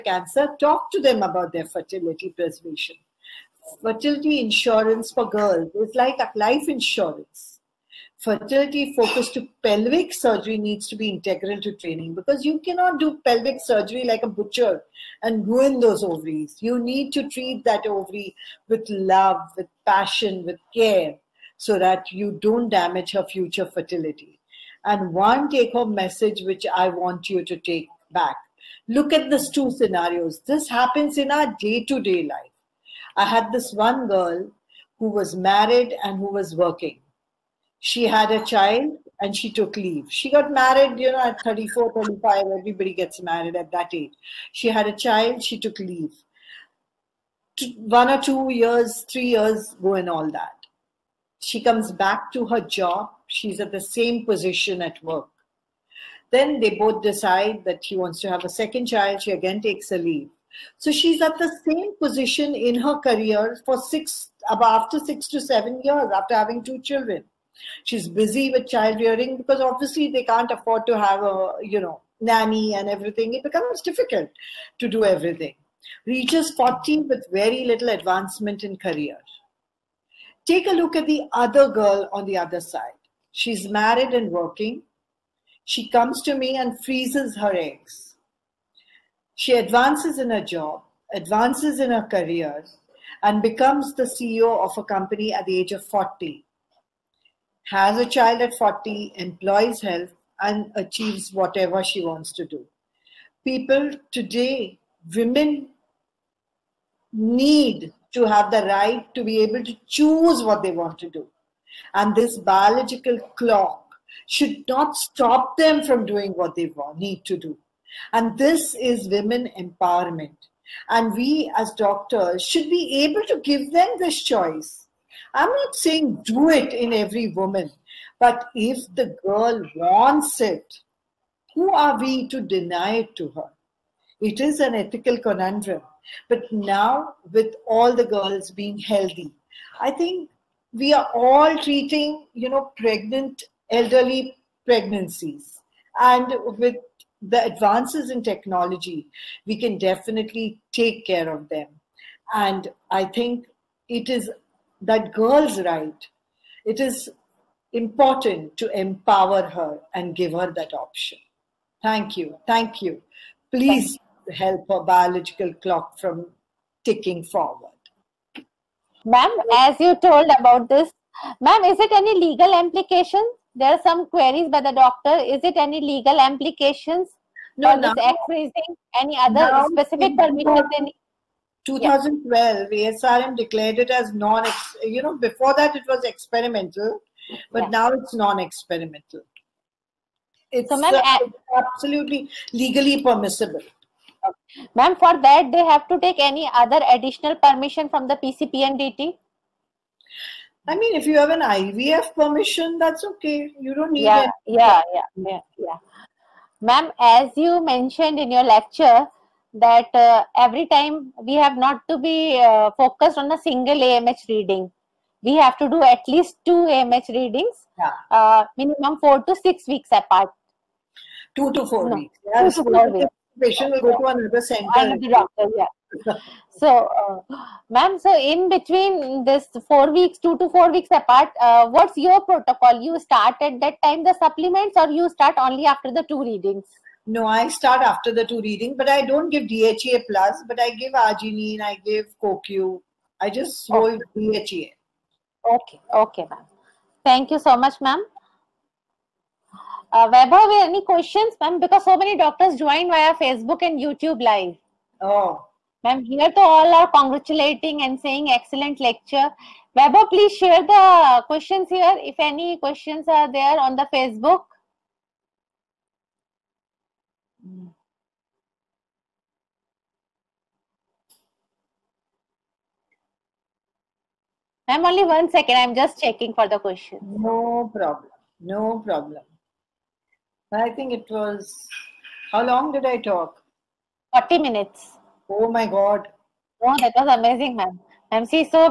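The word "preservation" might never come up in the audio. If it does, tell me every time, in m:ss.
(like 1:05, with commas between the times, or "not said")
0:02.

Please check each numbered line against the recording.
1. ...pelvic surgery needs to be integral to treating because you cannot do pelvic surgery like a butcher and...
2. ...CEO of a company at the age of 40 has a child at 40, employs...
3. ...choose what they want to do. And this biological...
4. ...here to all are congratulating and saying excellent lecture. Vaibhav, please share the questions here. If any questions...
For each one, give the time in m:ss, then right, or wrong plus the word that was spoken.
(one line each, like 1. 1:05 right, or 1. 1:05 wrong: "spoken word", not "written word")
1. 0:09 wrong: "training", not "treating"
2. 1:34 right
3. 1:49 right
4. 4:16 right.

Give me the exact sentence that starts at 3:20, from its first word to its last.
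I mean, if you have an IVF permission, that's okay.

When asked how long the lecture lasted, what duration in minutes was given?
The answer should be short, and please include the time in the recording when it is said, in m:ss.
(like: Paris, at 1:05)
40 minutes, at 4:44.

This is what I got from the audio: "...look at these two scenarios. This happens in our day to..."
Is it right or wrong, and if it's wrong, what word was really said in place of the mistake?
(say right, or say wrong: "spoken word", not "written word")
right.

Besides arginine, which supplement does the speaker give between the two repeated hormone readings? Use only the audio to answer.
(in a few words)
CoQ.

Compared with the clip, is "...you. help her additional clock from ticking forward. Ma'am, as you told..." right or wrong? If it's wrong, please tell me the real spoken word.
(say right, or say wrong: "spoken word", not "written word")
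wrong: "biological", not "additional".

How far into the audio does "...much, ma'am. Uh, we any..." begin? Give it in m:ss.
4:07.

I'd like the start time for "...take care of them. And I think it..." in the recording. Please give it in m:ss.
2:30.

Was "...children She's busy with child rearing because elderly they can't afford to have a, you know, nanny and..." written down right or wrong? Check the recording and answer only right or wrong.
wrong.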